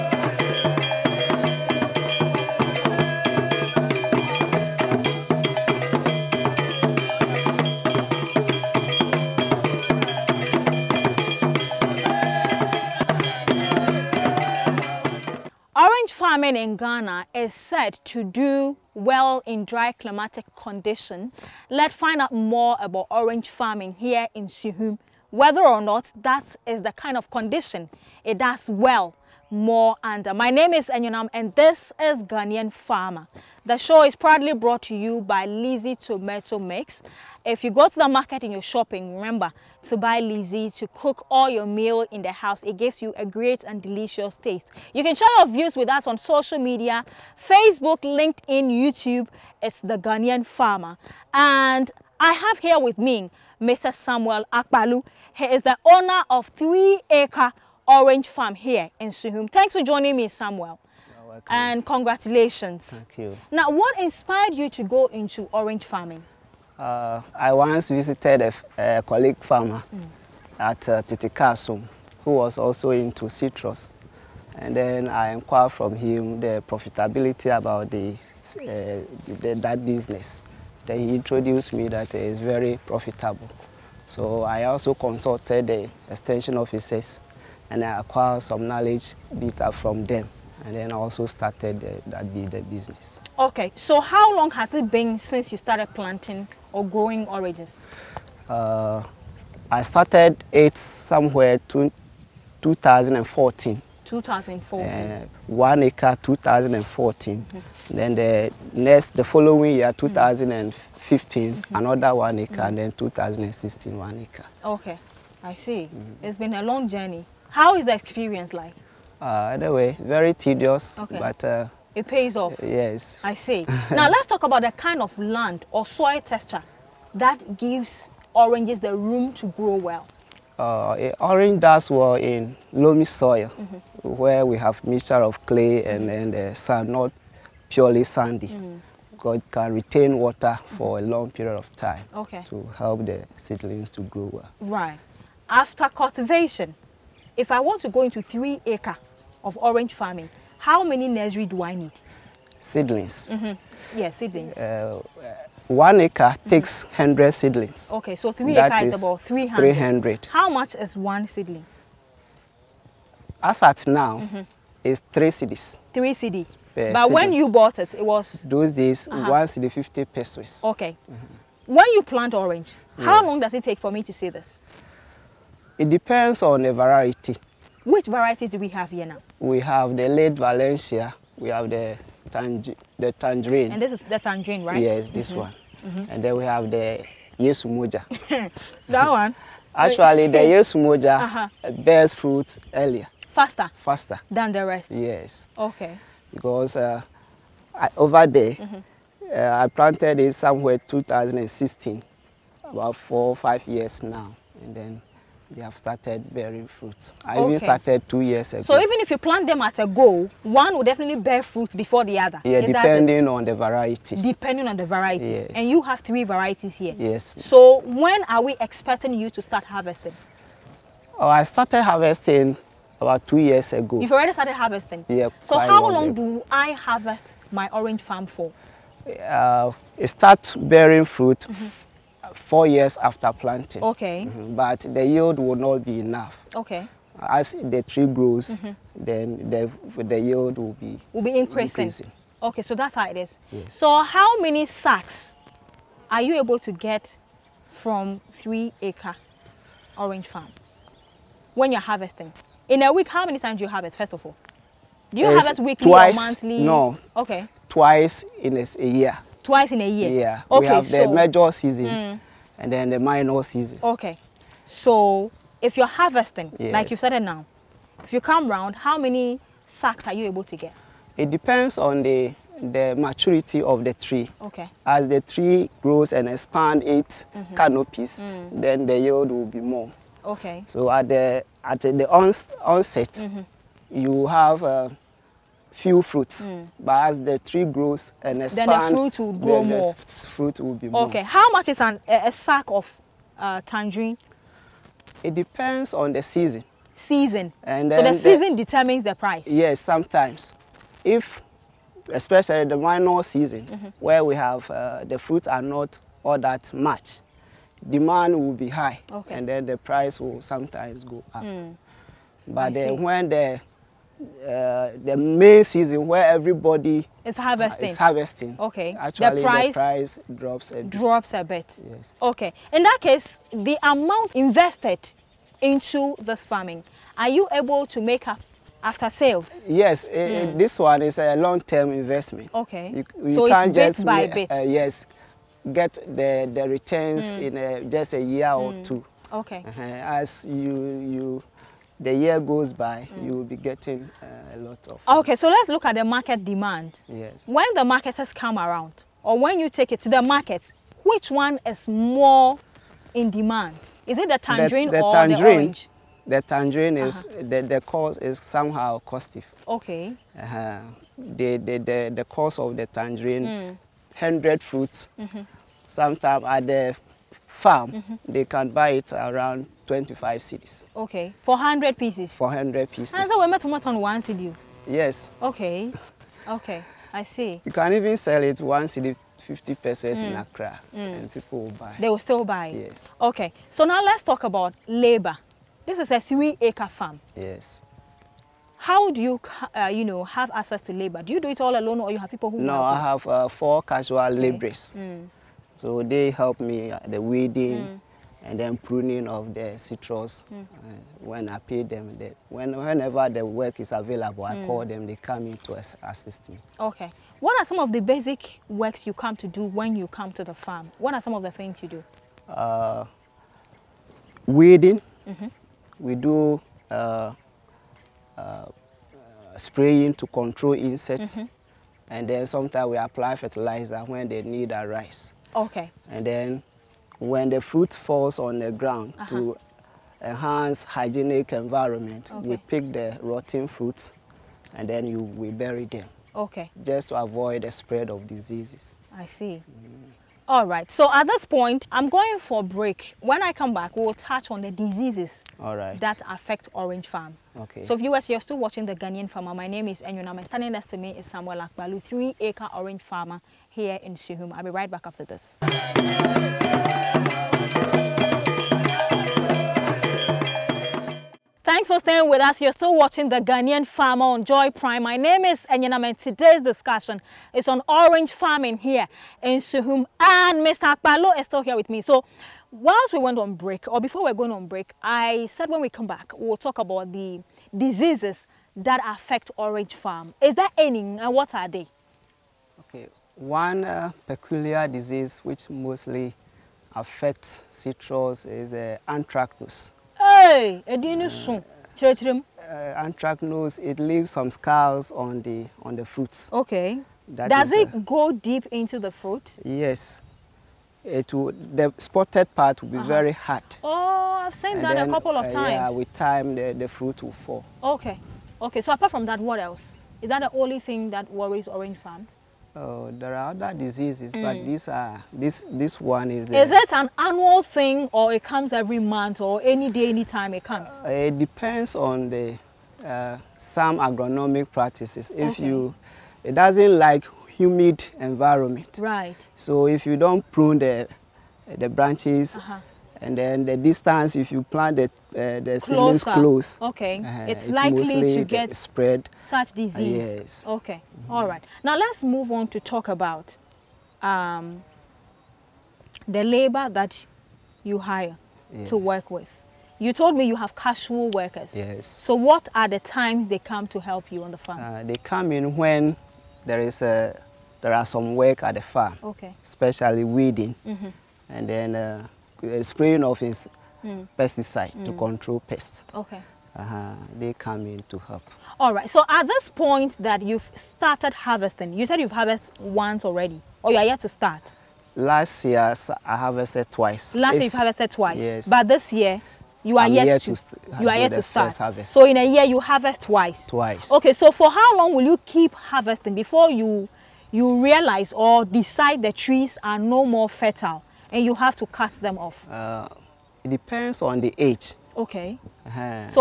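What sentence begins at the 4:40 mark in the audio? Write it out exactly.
So at the at the onset, mm -hmm.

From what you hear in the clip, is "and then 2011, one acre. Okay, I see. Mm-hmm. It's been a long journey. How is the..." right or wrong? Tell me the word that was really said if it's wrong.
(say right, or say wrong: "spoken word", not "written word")
wrong: "2016", not "2011".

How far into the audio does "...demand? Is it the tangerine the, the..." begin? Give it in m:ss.
5:53.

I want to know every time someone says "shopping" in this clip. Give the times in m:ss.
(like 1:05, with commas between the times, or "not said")
0:38.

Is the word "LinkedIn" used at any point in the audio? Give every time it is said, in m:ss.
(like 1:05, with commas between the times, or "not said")
0:48.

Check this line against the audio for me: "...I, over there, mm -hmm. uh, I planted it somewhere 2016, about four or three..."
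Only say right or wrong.
wrong.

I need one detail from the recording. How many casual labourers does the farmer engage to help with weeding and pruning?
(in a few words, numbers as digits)
4.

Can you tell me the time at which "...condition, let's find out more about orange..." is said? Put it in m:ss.
0:20.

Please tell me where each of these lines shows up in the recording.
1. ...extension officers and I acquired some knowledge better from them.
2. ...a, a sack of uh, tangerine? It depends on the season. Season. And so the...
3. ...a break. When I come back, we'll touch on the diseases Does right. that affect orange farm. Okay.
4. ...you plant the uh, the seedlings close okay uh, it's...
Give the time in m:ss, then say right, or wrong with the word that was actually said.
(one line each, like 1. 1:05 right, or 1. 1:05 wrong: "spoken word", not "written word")
1. 1:26 right
2. 4:52 right
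3. 7:22 wrong: "All", not "Does"
4. 8:54 right.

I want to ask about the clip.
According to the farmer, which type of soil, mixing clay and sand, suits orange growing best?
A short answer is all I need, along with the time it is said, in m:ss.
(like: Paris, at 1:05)
Loamy soil, at 2:12.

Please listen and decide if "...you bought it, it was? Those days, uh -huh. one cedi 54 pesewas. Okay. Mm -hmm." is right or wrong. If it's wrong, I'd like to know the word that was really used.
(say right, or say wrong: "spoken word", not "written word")
wrong: "50", not "54".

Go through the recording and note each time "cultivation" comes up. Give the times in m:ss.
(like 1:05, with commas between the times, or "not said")
2:25.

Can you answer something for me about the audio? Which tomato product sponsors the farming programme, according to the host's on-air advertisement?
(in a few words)
Lizzie Tomato Mix.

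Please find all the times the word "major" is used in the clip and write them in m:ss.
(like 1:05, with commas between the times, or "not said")
4:21.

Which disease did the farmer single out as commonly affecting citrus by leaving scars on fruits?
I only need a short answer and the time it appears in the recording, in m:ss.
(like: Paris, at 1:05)
Anthracnose, at 8:09.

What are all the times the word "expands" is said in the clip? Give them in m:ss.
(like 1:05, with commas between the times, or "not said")
4:36, 4:48.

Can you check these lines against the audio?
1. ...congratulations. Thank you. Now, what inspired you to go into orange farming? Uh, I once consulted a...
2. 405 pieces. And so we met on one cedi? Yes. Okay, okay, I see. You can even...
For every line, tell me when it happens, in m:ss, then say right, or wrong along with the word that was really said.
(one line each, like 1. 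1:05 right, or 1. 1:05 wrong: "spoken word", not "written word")
1. 1:01 wrong: "visited", not "consulted"
2. 6:12 wrong: "400", not "405".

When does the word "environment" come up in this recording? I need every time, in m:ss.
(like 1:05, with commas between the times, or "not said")
7:11, 8:48.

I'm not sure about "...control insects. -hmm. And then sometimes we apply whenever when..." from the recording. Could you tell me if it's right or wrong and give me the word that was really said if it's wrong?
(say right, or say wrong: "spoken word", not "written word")
wrong: "fertilizer", not "whenever".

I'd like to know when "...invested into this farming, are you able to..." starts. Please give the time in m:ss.
5:24.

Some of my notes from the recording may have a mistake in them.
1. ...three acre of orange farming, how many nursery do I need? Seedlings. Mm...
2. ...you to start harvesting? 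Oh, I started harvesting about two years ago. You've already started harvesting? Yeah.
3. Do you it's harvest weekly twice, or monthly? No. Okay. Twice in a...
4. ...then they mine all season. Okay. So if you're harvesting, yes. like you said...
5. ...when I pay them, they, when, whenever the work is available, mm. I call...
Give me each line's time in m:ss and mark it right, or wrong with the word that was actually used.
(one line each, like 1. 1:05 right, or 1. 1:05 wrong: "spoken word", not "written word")
1. 2:28 right
2. 3:39 right
3. 4:15 right
4. 4:22 right
5. 6:41 right.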